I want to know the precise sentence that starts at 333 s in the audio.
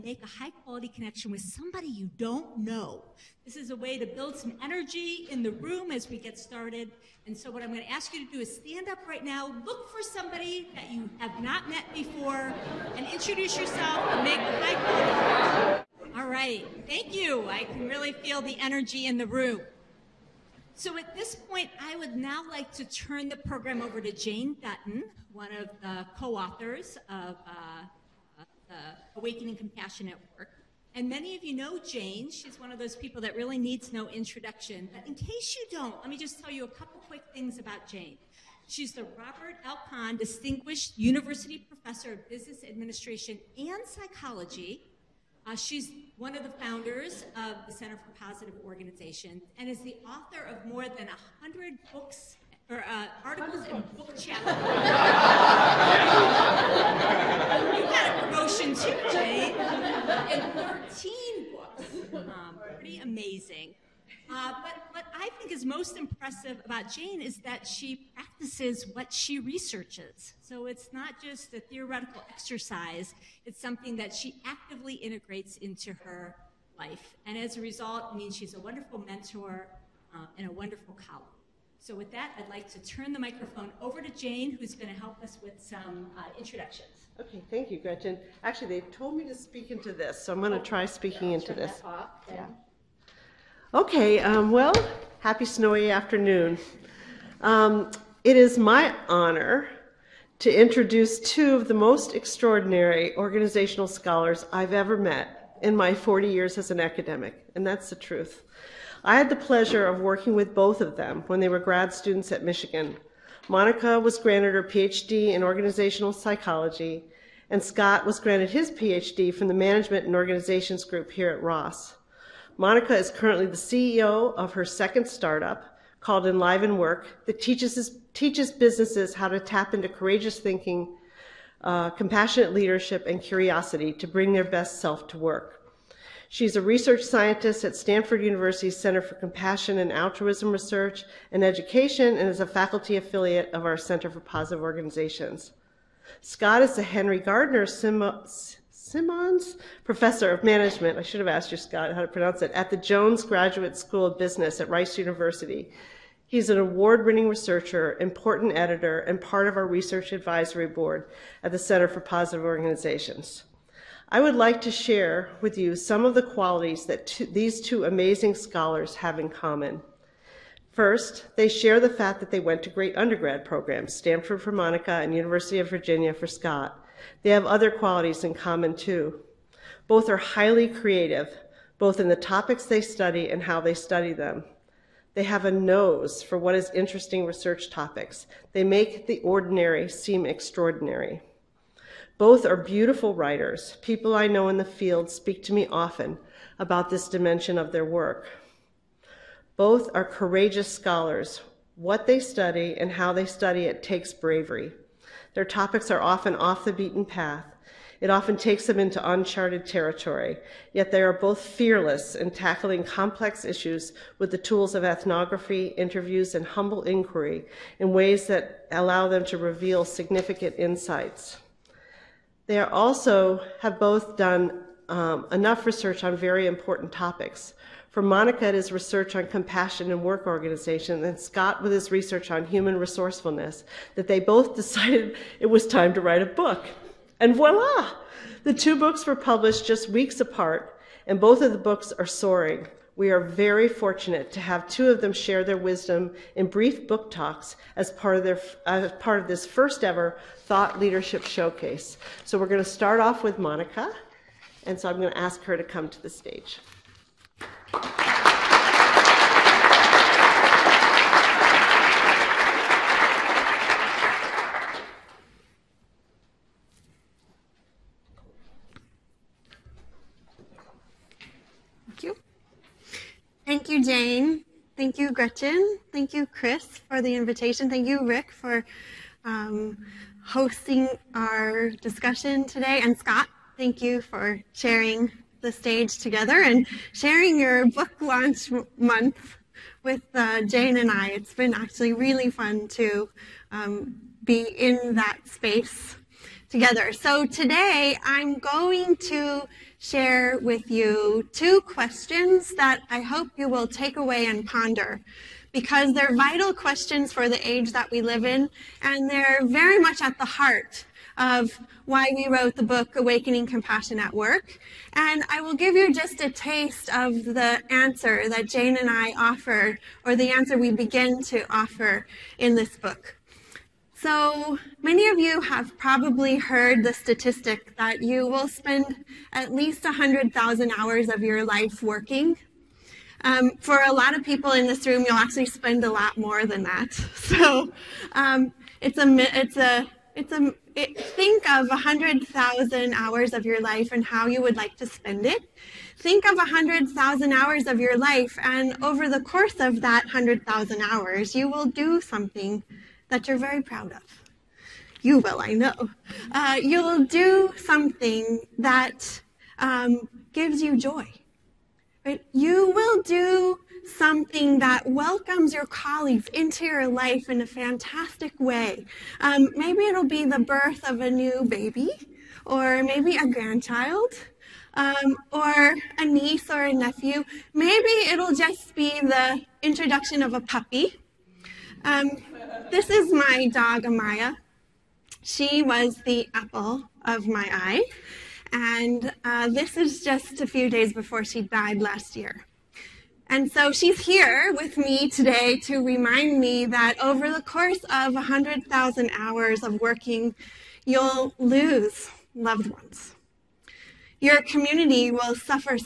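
Um, for a lot of people in this room, you'll actually spend a lot more than that.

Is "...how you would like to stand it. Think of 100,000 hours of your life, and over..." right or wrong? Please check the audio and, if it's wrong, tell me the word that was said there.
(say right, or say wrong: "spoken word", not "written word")
wrong: "spend", not "stand".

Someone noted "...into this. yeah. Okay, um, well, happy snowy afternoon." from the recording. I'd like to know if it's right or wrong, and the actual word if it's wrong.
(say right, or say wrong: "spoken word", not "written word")
right.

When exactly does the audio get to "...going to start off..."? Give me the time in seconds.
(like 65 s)
252 s.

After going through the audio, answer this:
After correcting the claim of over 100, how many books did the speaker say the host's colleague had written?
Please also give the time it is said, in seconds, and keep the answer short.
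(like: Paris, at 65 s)
13, at 60 s.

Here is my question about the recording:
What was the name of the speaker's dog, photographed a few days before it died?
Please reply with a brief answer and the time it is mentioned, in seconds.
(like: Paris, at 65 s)
Amaya, at 383 s.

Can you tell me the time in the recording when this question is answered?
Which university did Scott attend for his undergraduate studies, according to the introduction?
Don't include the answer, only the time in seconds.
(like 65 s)
175 s.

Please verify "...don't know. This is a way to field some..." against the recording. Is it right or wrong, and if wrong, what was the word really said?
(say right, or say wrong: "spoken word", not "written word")
wrong: "build", not "field".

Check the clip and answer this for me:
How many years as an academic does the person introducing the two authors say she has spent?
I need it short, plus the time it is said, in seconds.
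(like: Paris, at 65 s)
40, at 105 s.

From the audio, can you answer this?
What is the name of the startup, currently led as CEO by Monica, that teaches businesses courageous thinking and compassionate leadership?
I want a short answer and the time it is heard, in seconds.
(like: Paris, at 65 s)
Enliven Work, at 126 s.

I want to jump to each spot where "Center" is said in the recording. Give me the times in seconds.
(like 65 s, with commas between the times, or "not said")
47 s, 138 s, 143 s, 161 s.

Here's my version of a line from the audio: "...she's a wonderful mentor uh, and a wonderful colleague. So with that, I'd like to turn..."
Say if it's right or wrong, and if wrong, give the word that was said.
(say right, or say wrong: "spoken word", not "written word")
right.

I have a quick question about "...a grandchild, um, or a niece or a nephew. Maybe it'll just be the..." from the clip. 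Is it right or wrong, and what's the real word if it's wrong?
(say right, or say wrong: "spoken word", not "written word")
right.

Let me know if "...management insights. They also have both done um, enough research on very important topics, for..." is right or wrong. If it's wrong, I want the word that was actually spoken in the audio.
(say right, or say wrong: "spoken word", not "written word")
wrong: "significant", not "management".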